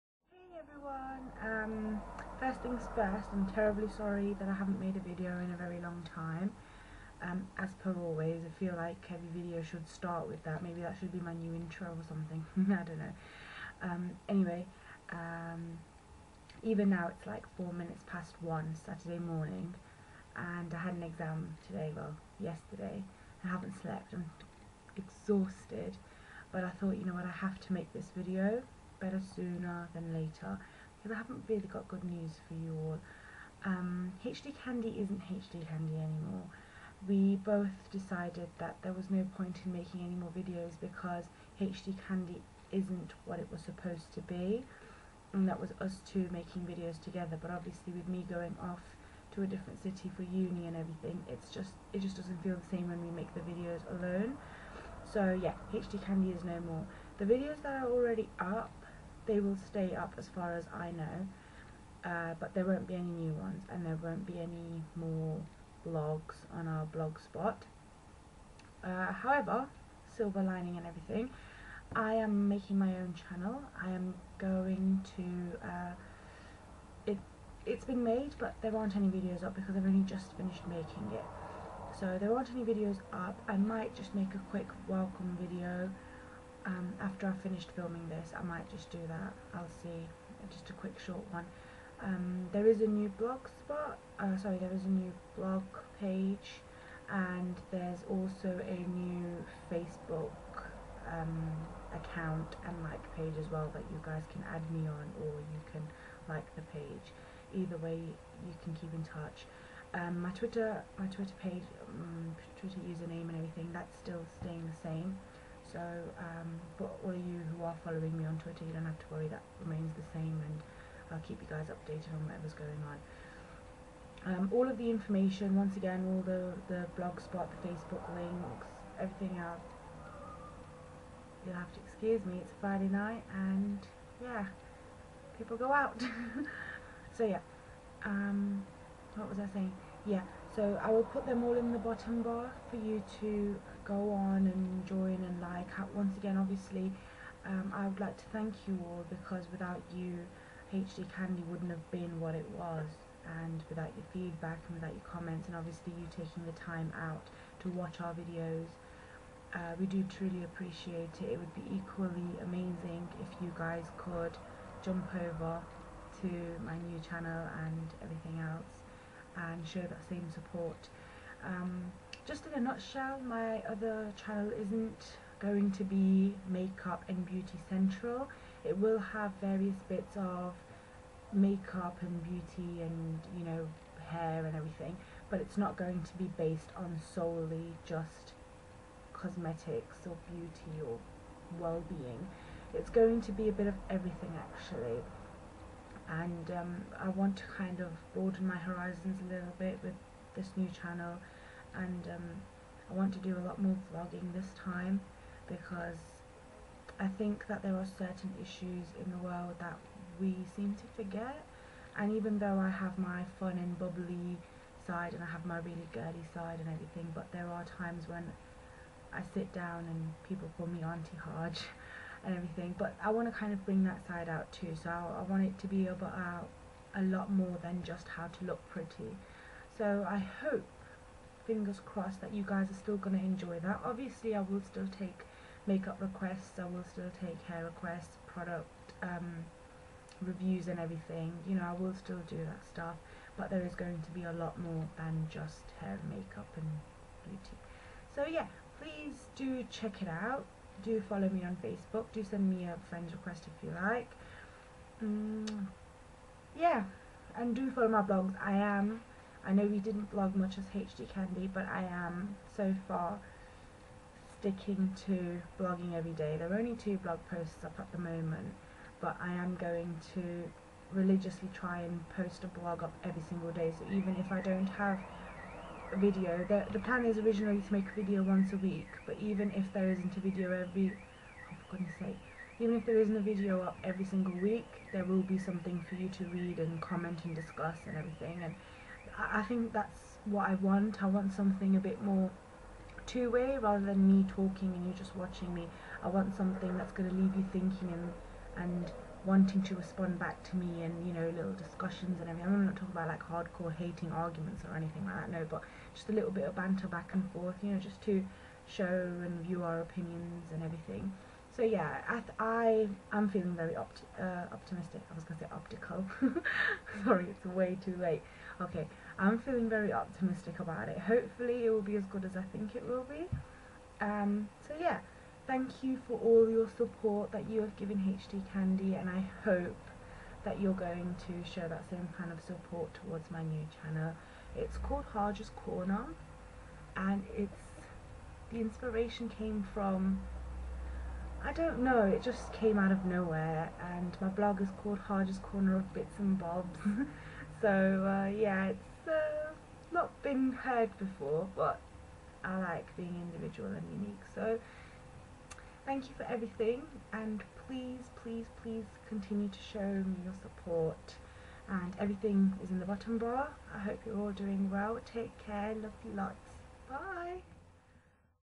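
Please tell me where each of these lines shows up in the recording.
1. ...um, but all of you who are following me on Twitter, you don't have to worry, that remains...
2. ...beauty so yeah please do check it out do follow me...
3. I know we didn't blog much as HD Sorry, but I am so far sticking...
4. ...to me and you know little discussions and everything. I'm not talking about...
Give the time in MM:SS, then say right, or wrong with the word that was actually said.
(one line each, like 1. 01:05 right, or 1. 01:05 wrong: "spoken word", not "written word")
1. 01:56 right
2. 04:07 right
3. 04:19 wrong: "Candy", not "Sorry"
4. 05:00 right.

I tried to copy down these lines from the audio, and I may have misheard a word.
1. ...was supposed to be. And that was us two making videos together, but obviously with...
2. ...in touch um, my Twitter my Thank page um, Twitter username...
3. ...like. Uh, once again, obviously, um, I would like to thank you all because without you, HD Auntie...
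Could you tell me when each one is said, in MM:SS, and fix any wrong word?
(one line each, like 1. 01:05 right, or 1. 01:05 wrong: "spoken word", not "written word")
1. 00:43 right
2. 01:48 wrong: "Twitter", not "Thank"
3. 02:25 wrong: "Candy", not "Auntie".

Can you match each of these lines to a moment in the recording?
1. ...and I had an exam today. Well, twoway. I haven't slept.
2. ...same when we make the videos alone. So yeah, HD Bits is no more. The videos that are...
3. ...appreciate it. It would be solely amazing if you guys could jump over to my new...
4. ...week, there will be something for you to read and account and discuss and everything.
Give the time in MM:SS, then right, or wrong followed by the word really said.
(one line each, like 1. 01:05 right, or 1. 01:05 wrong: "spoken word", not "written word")
1. 00:20 wrong: "yesterday", not "twoway"
2. 00:52 wrong: "Candy", not "Bits"
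3. 02:40 wrong: "equally", not "solely"
4. 04:44 wrong: "comment", not "account".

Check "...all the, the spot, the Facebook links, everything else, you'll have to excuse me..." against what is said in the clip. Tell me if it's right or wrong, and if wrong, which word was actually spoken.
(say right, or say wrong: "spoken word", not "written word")
right.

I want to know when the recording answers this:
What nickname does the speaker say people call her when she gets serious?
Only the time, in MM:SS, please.
03:40.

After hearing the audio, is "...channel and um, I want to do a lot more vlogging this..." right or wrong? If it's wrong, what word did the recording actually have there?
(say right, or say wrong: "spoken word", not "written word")
right.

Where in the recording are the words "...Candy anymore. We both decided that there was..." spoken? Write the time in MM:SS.
00:35.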